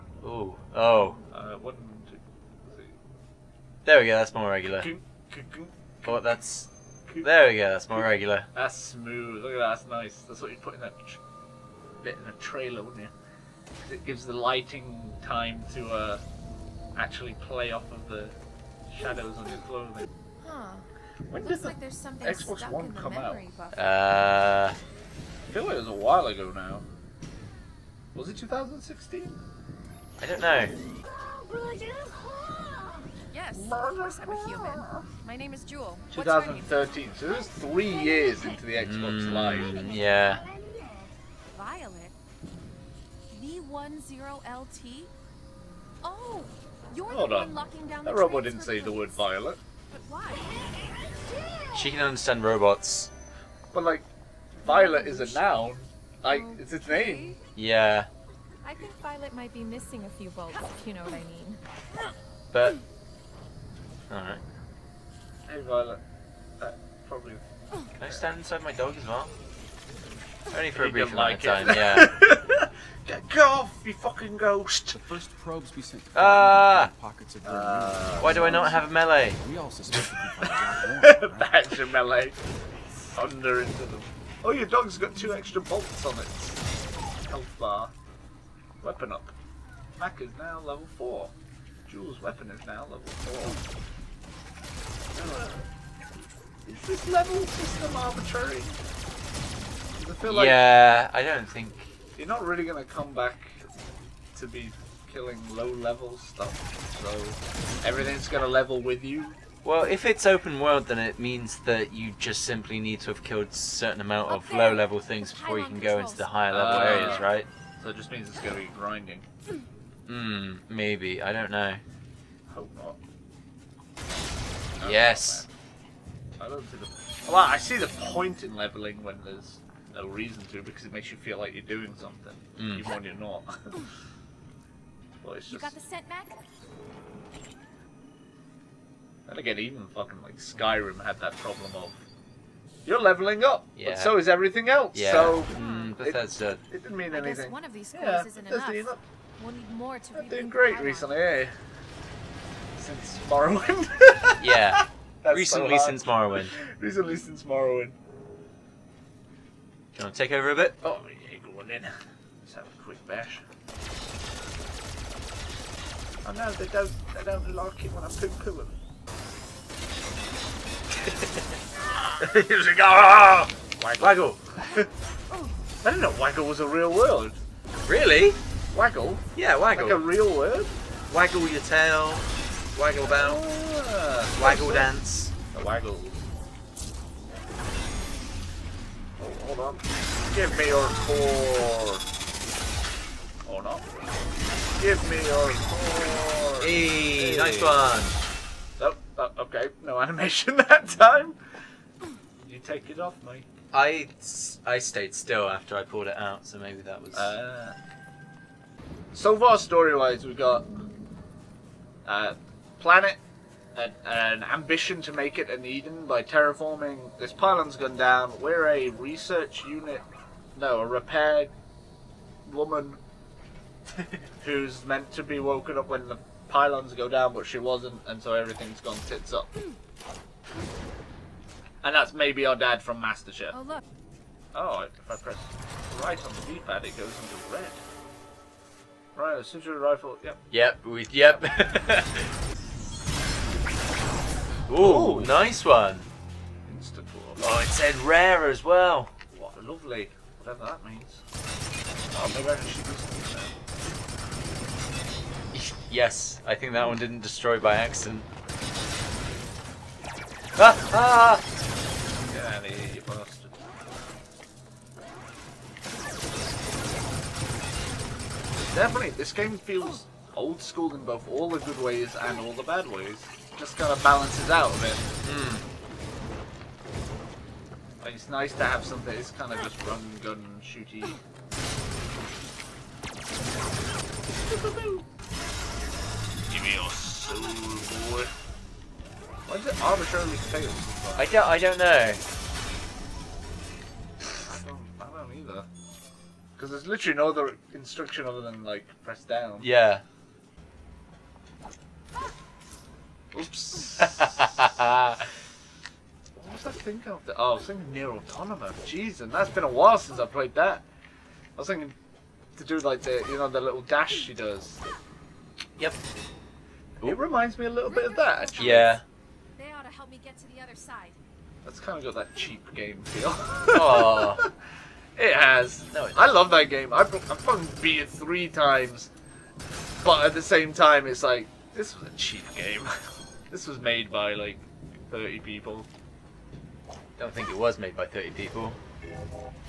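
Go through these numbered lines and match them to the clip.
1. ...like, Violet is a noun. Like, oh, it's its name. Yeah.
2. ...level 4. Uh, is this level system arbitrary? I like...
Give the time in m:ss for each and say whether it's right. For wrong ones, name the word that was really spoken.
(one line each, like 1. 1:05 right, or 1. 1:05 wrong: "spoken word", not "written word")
1. 0:53 right
2. 1:32 right.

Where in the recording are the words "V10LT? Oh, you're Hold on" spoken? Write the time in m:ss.
0:43.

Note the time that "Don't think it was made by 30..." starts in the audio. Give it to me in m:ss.
5:37.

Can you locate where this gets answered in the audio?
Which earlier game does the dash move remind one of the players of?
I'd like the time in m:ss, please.
5:07.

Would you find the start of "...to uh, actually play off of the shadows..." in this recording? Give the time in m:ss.
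0:15.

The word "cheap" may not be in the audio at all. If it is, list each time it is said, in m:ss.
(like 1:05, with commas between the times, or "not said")
5:22, 5:32.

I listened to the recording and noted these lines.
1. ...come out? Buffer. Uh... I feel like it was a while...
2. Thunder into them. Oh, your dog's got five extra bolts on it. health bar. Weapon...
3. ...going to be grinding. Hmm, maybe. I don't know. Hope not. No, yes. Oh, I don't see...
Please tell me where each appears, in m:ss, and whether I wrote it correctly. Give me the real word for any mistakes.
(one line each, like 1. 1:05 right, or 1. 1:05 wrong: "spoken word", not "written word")
1. 0:22 right
2. 1:22 wrong: "two", not "five"
3. 1:58 right.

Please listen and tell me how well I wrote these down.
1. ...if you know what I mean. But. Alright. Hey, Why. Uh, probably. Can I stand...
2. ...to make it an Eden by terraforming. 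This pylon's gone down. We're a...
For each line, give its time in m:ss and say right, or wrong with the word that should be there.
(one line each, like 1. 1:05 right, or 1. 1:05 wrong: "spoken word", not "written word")
1. 1:00 wrong: "Violet", not "Why"
2. 3:35 right.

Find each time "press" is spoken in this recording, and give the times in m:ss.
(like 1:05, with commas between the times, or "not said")
3:55, 4:59.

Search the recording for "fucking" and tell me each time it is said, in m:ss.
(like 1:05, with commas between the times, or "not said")
1:13, 2:19, 5:27.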